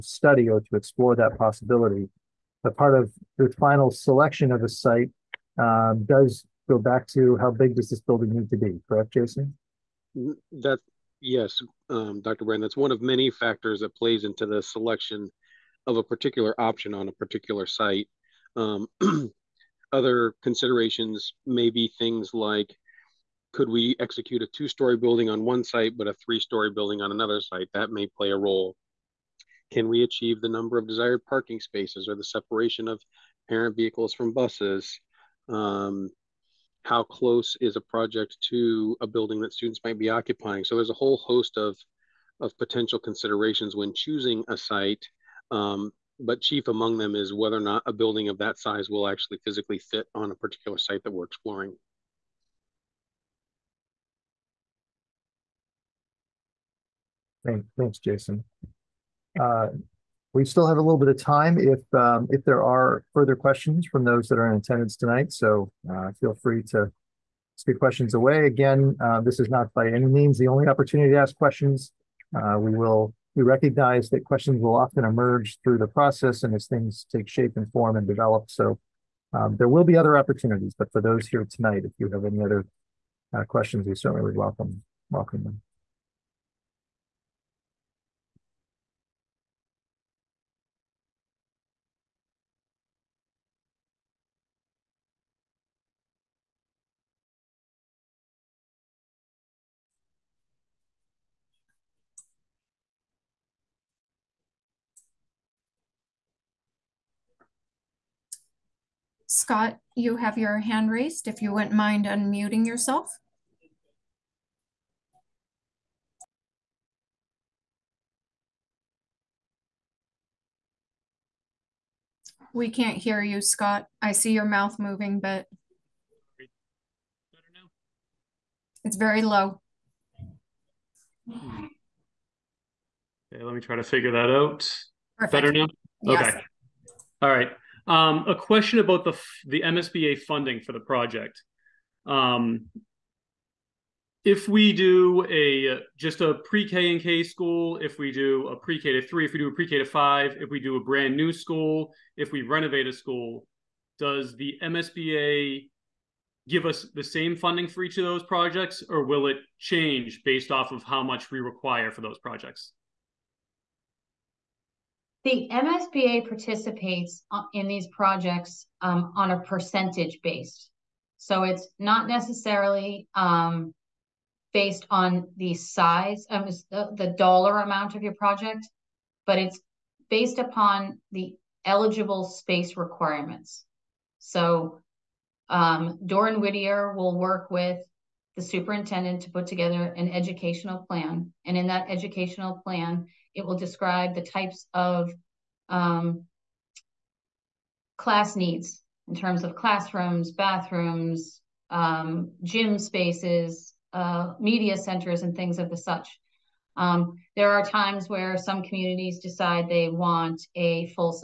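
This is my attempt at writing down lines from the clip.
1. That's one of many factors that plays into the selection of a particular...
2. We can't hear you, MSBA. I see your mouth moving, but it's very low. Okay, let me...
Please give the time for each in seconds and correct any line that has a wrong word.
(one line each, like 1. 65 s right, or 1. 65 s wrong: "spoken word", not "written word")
1. 12 s right
2. 122 s wrong: "Scott", not "MSBA".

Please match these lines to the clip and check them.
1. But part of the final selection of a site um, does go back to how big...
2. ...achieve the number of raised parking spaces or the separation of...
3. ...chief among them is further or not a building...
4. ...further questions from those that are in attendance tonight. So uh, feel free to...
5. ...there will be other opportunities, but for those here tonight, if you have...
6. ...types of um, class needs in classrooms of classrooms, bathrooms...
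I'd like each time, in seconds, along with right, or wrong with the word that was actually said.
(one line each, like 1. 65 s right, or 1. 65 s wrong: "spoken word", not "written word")
1. 2 s right
2. 30 s wrong: "desired", not "raised"
3. 46 s wrong: "whether", not "further"
4. 63 s right
5. 79 s right
6. 194 s wrong: "terms", not "classrooms".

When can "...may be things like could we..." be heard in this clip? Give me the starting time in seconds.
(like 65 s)
21 s.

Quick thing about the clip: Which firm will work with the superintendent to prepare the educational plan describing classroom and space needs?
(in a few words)
Dore and Whittier.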